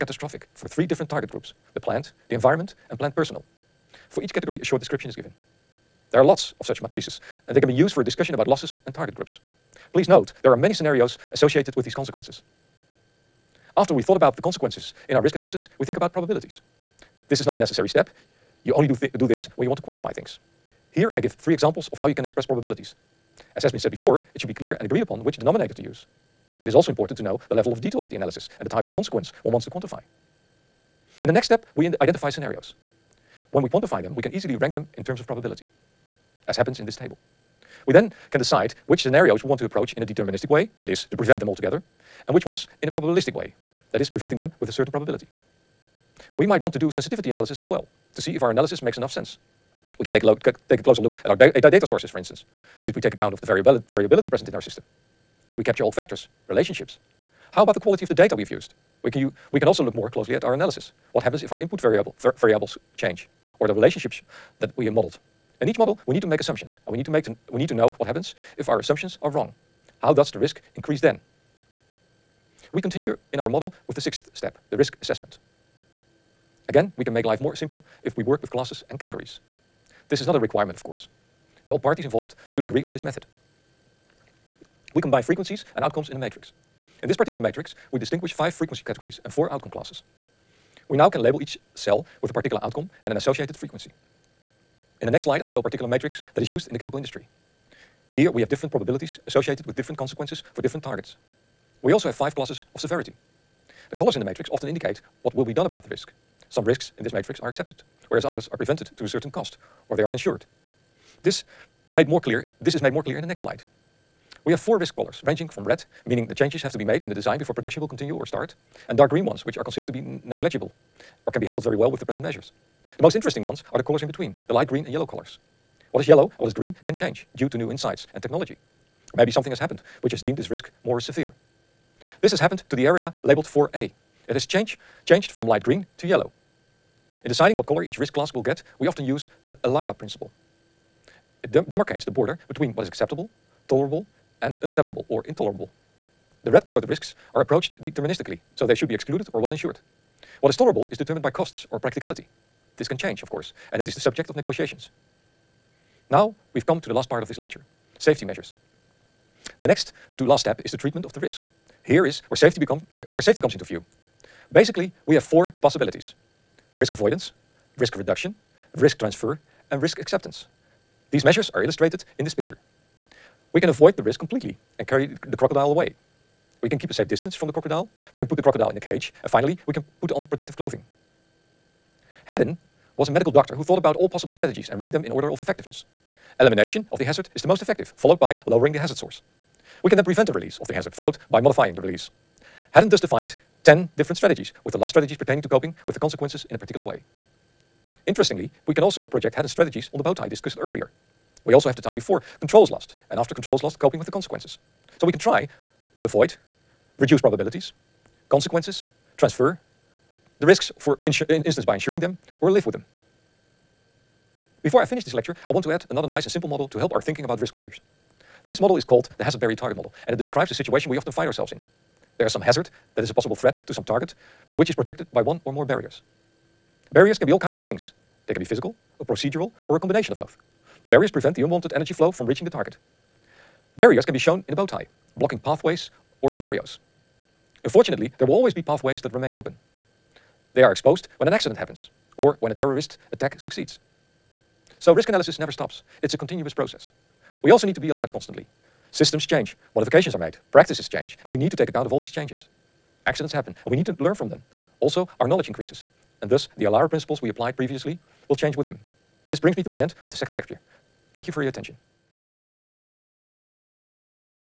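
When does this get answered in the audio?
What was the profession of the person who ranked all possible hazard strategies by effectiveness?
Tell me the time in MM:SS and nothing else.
03:03.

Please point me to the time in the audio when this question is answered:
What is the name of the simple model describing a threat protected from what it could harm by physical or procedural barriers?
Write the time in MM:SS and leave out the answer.
03:39.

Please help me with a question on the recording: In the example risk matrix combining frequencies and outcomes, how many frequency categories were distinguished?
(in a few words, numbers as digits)
5.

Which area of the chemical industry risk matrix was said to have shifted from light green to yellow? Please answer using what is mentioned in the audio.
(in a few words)
4A.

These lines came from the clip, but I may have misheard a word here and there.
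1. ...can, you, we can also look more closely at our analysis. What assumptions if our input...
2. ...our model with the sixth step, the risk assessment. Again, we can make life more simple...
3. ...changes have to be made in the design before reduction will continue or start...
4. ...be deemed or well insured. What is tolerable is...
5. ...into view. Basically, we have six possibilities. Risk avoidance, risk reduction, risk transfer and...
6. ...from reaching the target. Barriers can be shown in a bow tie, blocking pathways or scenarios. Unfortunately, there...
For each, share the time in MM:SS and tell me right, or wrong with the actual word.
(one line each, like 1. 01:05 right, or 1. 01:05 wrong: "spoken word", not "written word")
1. 00:59 wrong: "happens", not "assumptions"
2. 01:13 right
3. 01:56 wrong: "production", not "reduction"
4. 02:28 wrong: "excluded", not "deemed"
5. 02:43 wrong: "four", not "six"
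6. 03:52 right.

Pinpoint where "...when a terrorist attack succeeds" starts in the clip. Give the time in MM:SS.
04:02.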